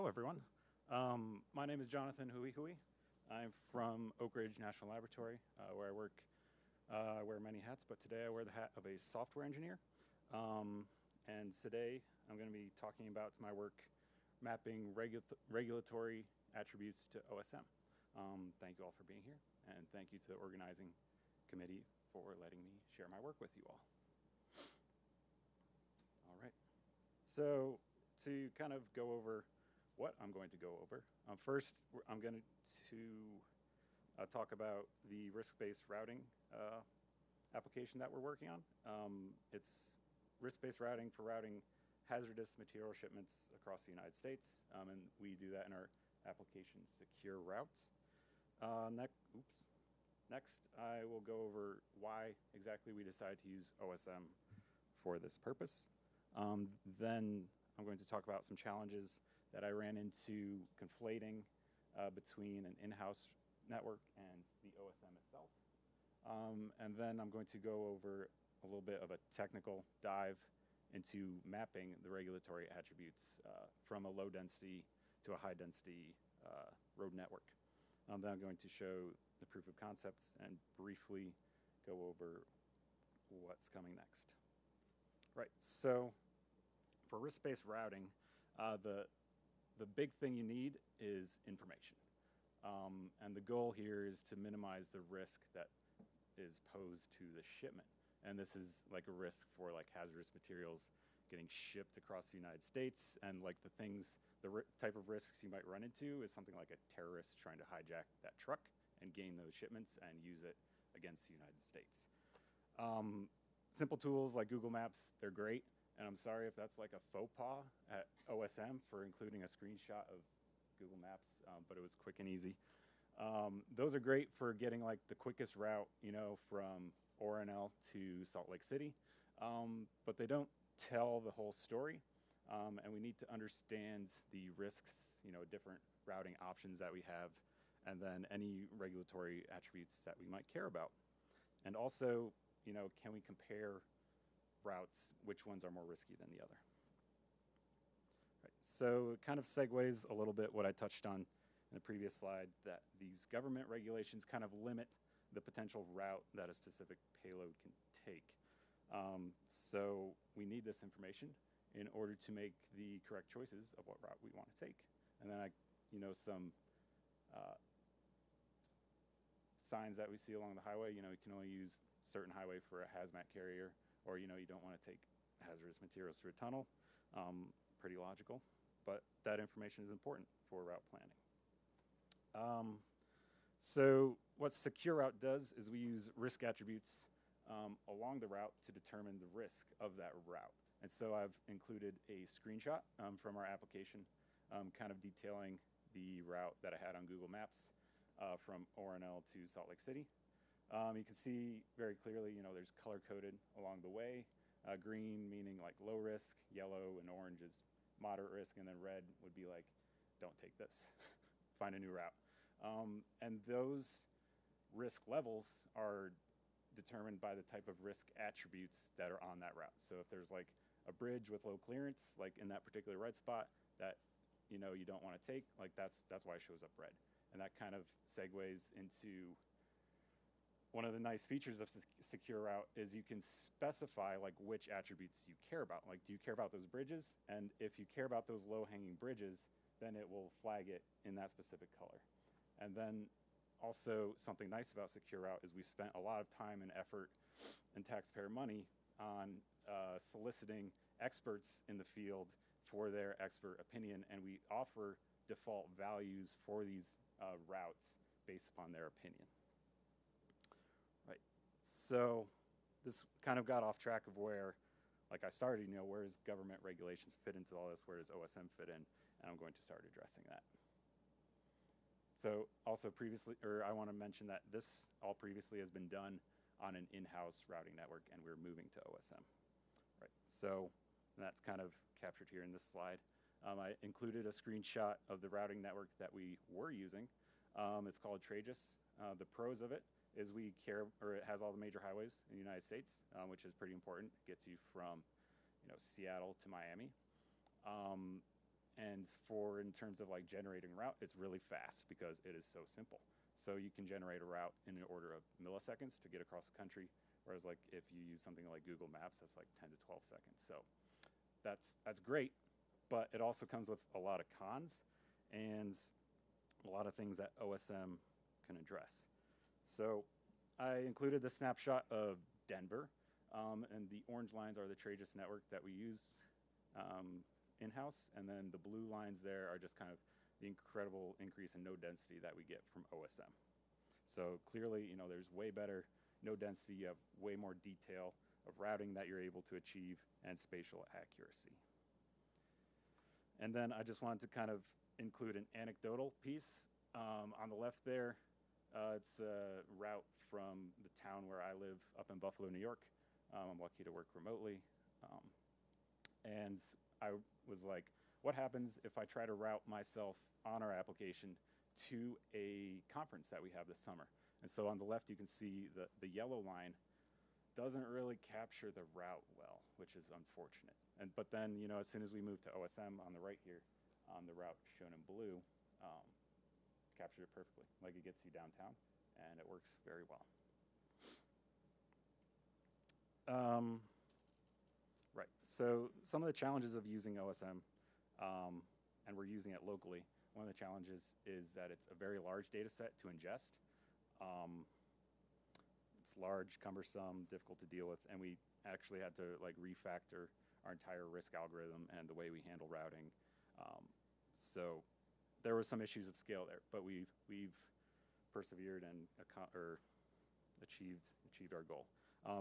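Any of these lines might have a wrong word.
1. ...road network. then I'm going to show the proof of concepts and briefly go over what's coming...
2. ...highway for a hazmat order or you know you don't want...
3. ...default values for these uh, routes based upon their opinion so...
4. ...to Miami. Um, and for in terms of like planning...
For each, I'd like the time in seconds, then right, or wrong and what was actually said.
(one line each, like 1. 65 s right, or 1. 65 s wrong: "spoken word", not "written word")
1. 76 s right
2. 172 s wrong: "carrier", not "order"
3. 255 s right
4. 296 s wrong: "generating", not "planning".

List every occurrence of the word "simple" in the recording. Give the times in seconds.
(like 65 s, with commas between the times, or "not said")
113 s, 302 s.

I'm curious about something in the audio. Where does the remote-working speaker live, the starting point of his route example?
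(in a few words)
Buffalo, New York.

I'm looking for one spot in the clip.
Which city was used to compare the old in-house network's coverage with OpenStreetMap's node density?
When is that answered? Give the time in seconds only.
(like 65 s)
322 s.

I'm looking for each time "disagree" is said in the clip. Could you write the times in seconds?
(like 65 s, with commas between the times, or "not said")
not said.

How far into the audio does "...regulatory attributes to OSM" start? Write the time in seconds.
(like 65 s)
15 s.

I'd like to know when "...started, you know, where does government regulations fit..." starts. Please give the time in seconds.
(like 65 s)
265 s.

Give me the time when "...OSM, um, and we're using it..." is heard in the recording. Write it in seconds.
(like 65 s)
387 s.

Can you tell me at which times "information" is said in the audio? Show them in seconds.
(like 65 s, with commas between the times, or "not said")
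91 s, 160 s, 179 s.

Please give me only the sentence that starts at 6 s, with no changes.
Uh, I wear many hats, but today I wear the hat of a software engineer.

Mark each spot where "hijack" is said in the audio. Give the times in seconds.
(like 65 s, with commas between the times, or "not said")
107 s.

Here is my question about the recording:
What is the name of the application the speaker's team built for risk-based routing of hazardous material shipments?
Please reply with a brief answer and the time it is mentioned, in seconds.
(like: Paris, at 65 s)
Secure Routes, at 46 s.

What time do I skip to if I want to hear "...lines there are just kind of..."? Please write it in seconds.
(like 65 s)
328 s.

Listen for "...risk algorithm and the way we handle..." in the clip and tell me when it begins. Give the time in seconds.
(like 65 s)
401 s.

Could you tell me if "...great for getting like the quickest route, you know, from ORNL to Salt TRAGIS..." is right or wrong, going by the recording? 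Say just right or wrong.
wrong.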